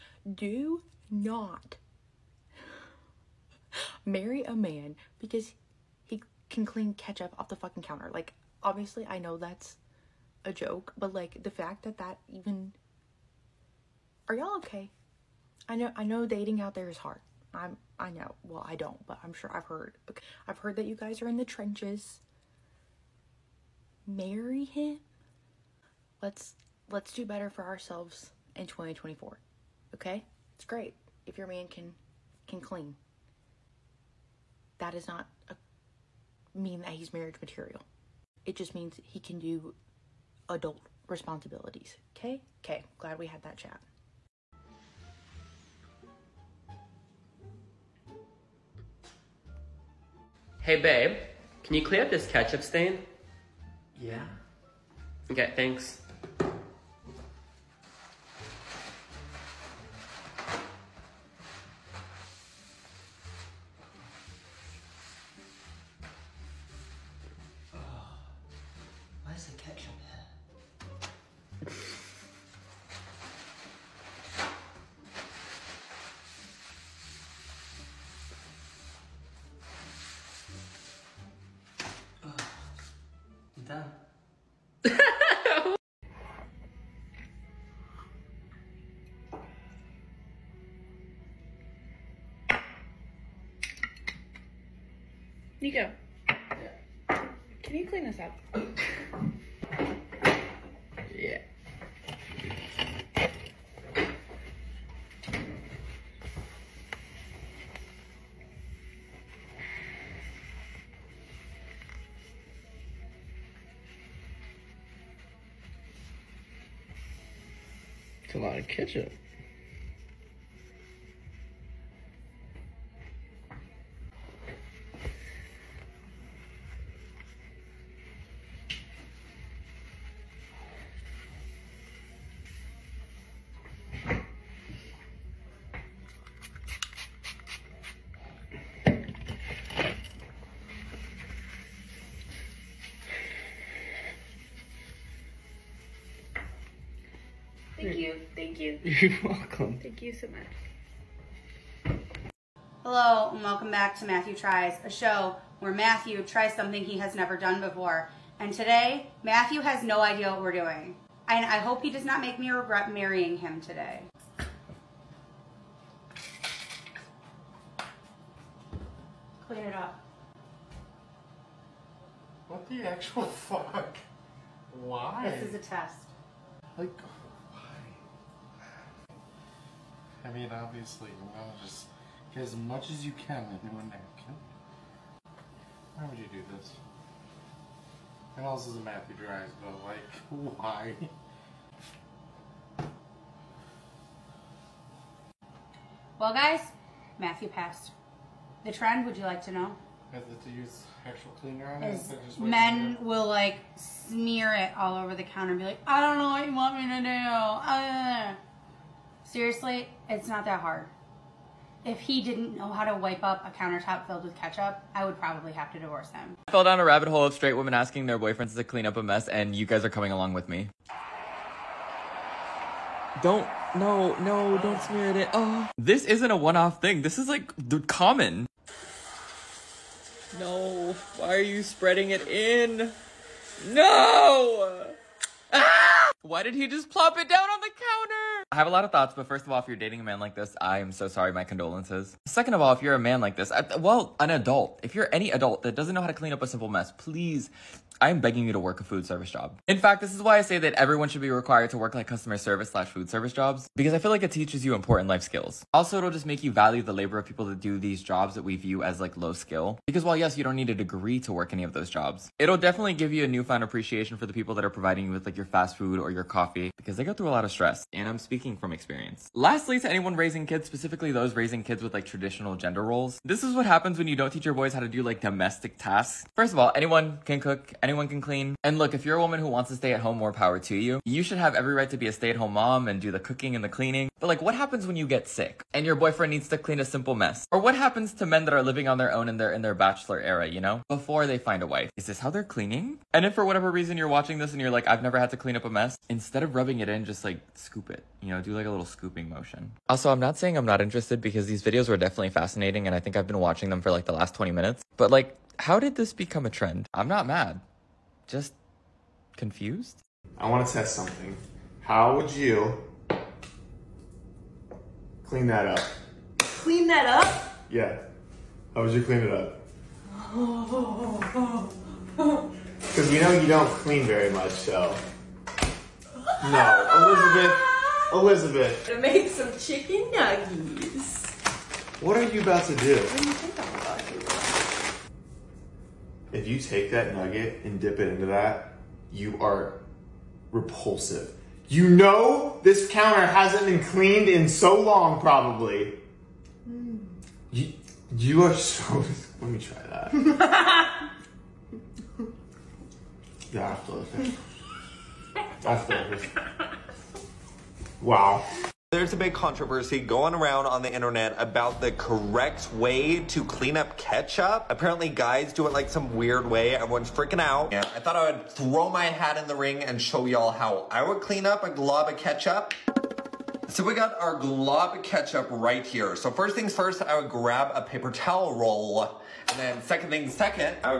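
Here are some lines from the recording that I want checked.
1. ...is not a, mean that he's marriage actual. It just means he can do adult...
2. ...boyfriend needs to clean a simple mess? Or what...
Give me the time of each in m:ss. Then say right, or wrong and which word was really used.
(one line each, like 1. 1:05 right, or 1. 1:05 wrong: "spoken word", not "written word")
1. 0:34 wrong: "material", not "actual"
2. 4:45 right.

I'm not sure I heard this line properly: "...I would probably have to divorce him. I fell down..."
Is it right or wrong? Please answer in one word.
right.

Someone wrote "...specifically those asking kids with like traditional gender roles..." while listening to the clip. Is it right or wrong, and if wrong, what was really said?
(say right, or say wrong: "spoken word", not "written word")
wrong: "raising", not "asking".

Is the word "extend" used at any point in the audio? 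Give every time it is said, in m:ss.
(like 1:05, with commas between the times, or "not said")
not said.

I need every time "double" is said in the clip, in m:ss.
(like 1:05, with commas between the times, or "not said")
not said.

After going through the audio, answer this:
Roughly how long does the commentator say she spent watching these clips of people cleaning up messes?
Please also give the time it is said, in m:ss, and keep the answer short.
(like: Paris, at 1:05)
20 minutes, at 5:04.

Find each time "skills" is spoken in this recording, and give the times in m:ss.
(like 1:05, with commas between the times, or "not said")
4:15, 4:19.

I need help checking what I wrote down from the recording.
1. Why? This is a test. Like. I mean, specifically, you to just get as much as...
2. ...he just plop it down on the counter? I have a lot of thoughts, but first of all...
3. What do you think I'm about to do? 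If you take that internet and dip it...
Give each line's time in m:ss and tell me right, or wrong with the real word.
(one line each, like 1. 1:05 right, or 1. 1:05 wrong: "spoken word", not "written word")
1. 2:54 wrong: "obviously", not "specifically"
2. 3:56 right
3. 5:32 wrong: "nugget", not "internet".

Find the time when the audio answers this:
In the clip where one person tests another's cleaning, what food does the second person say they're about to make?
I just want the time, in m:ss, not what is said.
5:29.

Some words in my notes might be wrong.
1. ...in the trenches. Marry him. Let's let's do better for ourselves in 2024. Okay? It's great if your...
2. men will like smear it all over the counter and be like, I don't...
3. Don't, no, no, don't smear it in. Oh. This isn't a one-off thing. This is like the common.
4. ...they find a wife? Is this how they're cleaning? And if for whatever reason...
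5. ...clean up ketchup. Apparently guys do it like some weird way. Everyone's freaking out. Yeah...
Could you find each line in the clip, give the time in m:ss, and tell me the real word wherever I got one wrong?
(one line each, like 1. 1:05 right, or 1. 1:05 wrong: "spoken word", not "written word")
1. 0:21 right
2. 3:22 right
3. 3:43 right
4. 4:51 right
5. 6:03 right.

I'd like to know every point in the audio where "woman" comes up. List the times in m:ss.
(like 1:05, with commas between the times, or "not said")
4:39.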